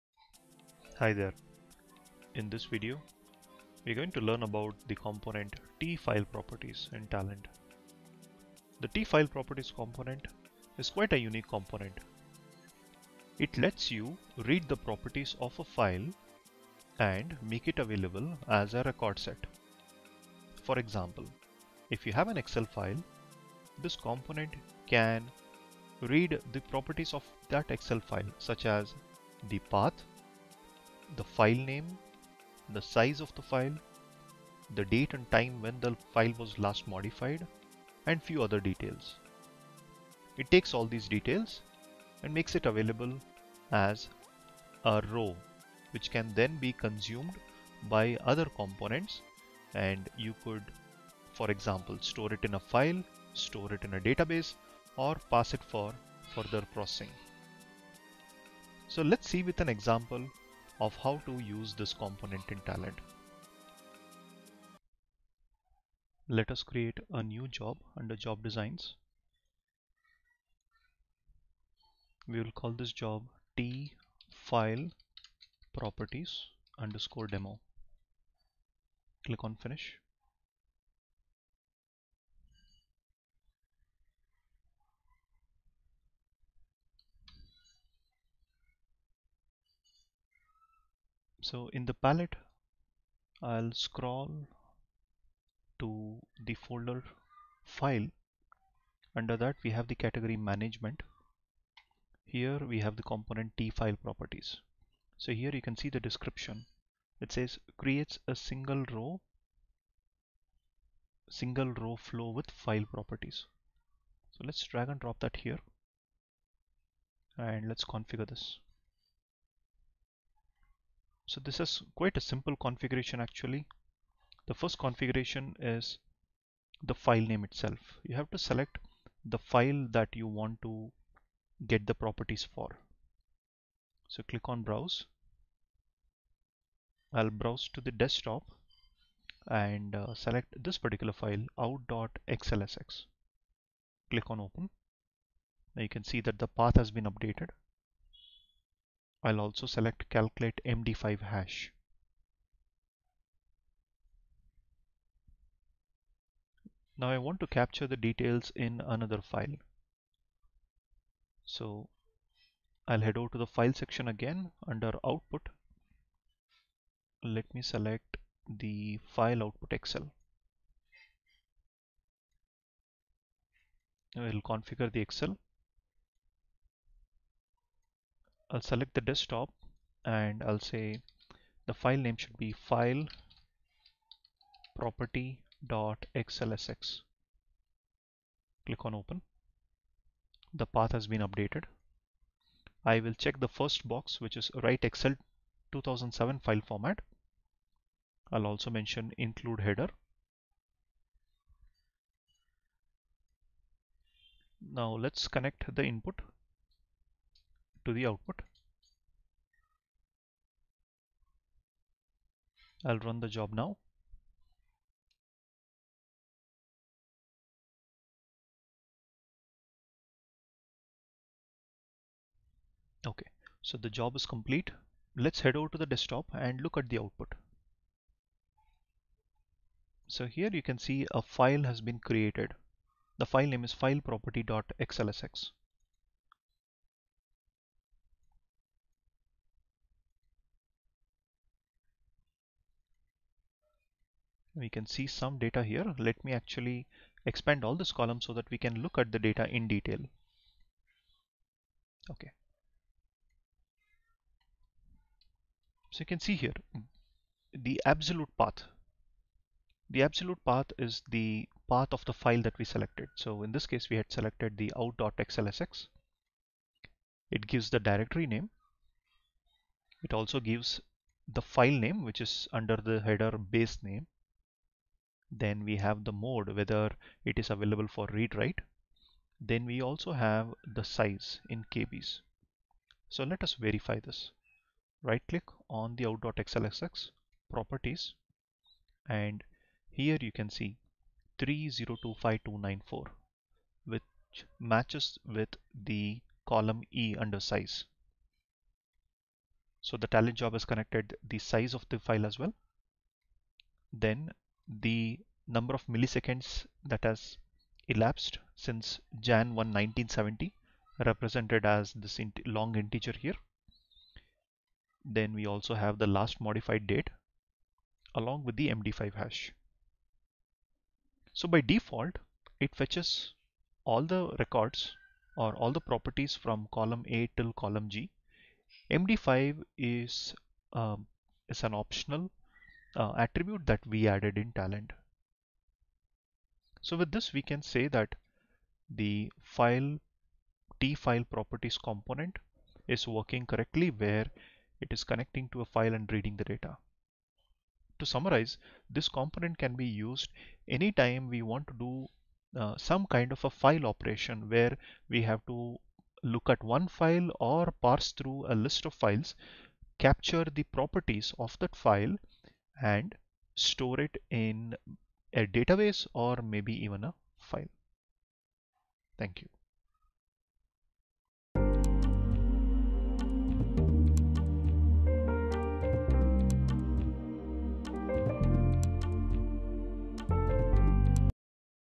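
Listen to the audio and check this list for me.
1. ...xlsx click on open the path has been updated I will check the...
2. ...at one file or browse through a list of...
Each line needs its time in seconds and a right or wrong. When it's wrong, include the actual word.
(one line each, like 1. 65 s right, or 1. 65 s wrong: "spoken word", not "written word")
1. 184 s right
2. 356 s wrong: "parse", not "browse".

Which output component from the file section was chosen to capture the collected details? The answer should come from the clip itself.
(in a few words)
file output Excel.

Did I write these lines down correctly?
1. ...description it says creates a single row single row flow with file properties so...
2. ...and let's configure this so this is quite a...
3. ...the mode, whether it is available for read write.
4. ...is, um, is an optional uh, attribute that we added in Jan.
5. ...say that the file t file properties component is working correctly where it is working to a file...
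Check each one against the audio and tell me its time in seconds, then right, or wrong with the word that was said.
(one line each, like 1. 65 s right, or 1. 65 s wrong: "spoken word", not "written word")
1. 106 s right
2. 117 s right
3. 276 s right
4. 329 s wrong: "Talend", not "Jan"
5. 337 s wrong: "connecting", not "working".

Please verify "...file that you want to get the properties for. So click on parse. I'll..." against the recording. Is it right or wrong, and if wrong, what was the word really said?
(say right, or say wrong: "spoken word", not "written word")
wrong: "browse", not "parse".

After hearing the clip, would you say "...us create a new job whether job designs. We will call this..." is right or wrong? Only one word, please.
wrong.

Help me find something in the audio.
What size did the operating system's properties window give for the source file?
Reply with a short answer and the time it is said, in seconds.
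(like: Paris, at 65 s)
3025294, at 291 s.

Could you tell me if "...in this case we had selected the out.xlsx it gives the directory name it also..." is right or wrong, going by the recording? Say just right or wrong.
right.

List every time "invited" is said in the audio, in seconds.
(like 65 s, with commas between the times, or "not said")
not said.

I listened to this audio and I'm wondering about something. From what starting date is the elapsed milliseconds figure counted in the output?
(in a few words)
Jan 1, 1970.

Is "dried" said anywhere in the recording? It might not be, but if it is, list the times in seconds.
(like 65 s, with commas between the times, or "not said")
not said.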